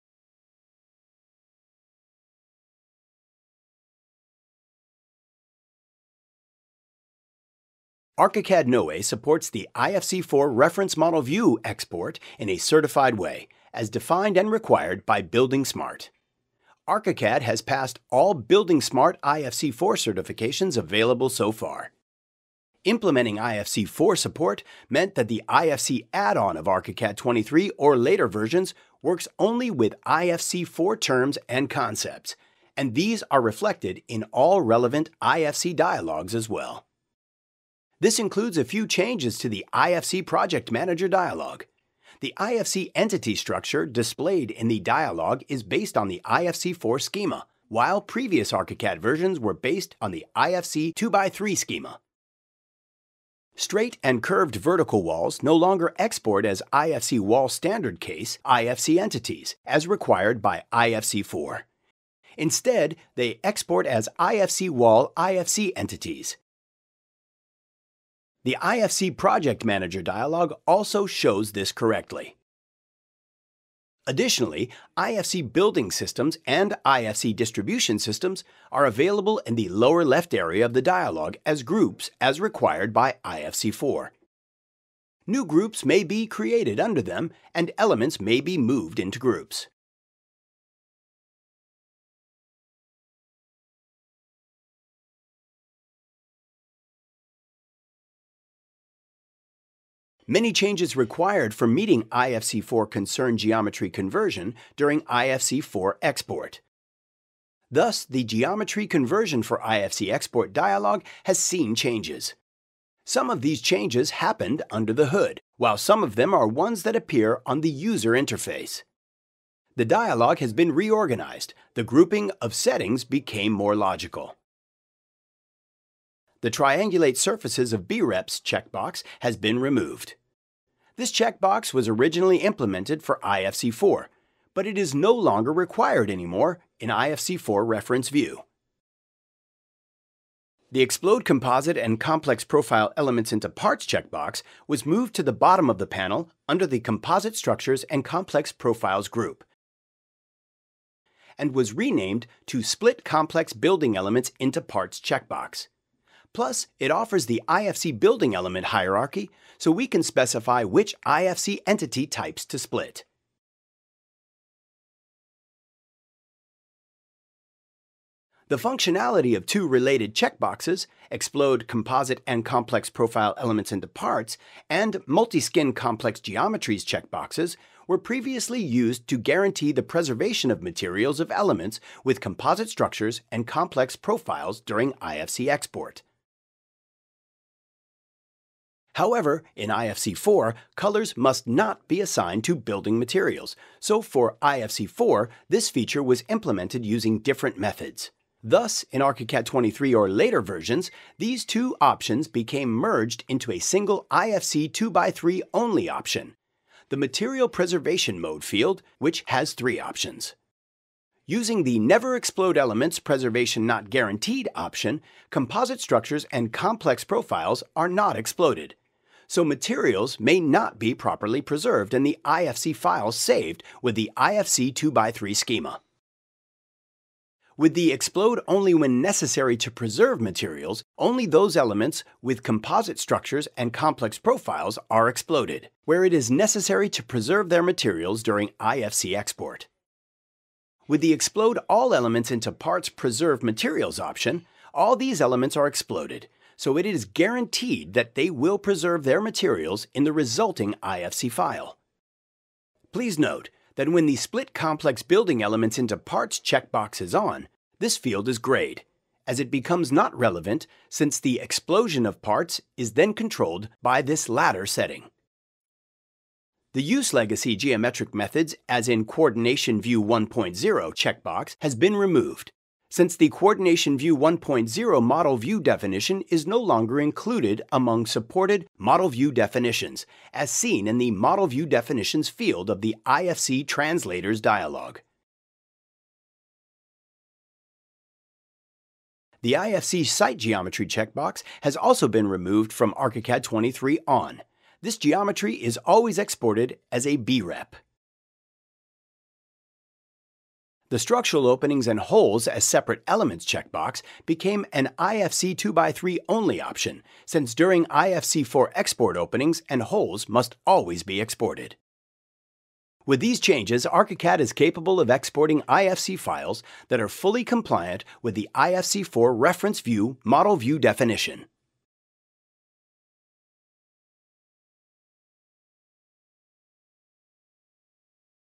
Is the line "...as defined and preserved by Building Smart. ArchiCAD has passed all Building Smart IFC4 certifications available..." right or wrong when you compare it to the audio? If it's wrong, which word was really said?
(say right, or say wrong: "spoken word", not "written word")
wrong: "required", not "preserved".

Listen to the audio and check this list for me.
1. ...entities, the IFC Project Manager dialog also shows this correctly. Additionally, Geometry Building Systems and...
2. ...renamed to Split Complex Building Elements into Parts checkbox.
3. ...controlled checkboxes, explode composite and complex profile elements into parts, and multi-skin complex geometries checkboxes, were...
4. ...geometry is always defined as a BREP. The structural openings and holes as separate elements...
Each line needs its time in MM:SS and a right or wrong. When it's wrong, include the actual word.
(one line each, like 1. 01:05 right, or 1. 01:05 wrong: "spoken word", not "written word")
1. 01:05 wrong: "IFC", not "Geometry"
2. 02:31 right
3. 02:49 wrong: "related", not "controlled"
4. 04:54 wrong: "exported", not "defined".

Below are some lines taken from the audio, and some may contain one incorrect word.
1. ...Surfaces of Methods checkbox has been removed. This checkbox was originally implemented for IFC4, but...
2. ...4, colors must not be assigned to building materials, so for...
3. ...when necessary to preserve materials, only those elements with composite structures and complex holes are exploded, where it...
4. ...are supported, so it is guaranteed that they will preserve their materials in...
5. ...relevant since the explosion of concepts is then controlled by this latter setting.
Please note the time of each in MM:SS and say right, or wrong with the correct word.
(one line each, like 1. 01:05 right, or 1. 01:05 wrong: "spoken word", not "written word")
1. 02:07 wrong: "BREPS", not "Methods"
2. 03:10 right
3. 03:48 wrong: "profiles", not "holes"
4. 04:05 wrong: "exploded", not "supported"
5. 04:20 wrong: "parts", not "concepts".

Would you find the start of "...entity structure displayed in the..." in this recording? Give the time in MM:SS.
00:42.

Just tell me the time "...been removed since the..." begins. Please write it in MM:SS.
04:31.